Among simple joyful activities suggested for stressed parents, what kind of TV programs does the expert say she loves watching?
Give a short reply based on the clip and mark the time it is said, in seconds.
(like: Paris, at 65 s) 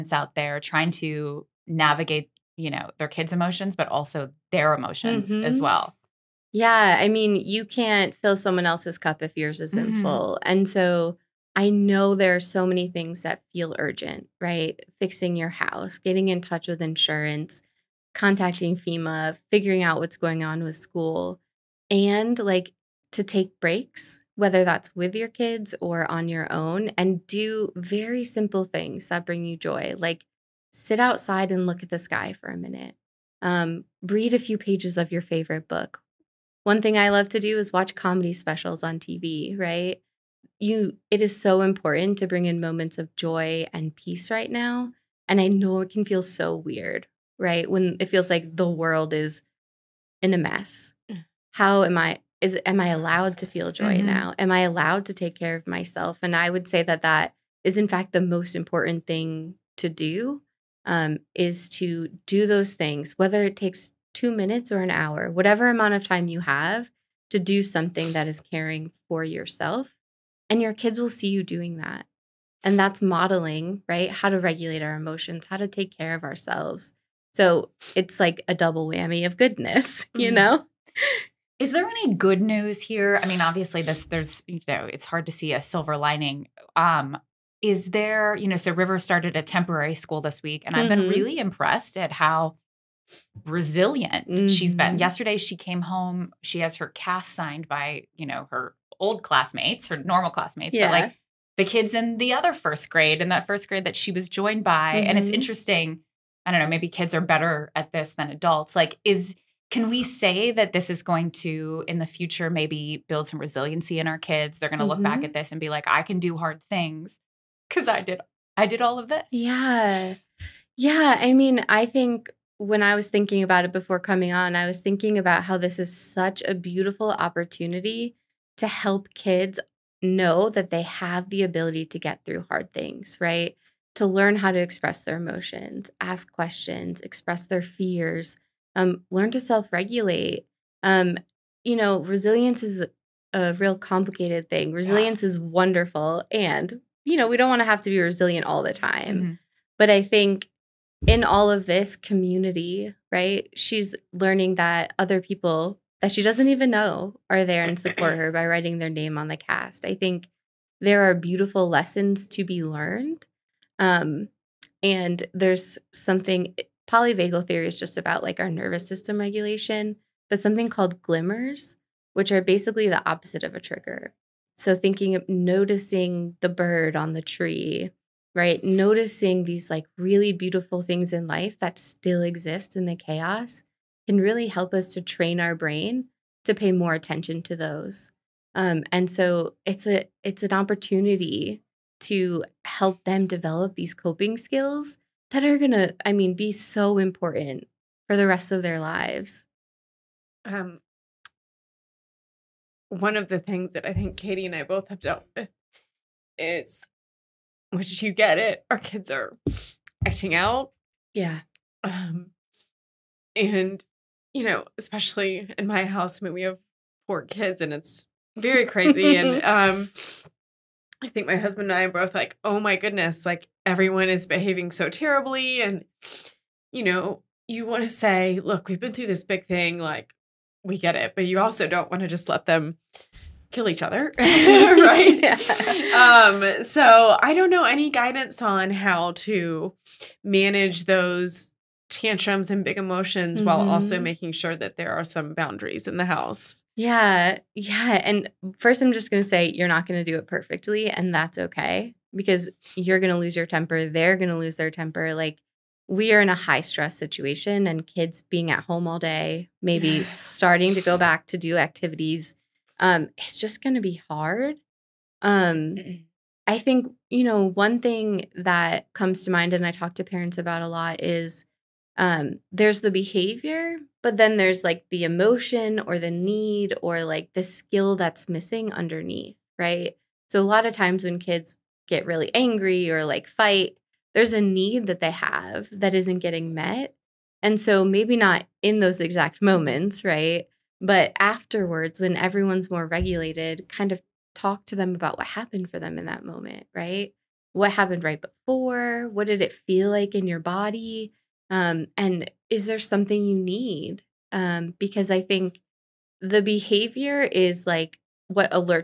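Comedy specials, at 37 s.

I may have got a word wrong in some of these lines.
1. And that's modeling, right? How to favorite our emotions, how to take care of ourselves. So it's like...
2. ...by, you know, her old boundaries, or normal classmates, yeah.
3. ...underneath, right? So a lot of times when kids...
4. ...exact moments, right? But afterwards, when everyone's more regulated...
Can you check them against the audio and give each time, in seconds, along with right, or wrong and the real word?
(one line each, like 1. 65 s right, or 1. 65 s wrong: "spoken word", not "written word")
1. 72 s wrong: "regulate", not "favorite"
2. 97 s wrong: "classmates", not "boundaries"
3. 278 s right
4. 288 s right.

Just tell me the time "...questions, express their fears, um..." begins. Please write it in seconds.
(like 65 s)
136 s.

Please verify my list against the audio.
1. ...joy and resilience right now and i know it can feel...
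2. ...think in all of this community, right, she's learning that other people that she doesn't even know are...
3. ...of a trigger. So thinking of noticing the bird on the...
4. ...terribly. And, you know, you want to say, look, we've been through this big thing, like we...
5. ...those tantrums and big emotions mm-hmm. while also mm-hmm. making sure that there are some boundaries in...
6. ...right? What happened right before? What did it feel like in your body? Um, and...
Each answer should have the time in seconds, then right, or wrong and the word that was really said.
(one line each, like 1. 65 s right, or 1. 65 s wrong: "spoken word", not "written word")
1. 43 s wrong: "peace", not "resilience"
2. 150 s right
3. 173 s right
4. 224 s right
5. 240 s right
6. 296 s right.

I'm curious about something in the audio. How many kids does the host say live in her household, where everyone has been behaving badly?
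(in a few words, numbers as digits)
4.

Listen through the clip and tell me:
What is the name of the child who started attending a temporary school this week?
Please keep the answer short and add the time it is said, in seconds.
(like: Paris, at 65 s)
River, at 88 s.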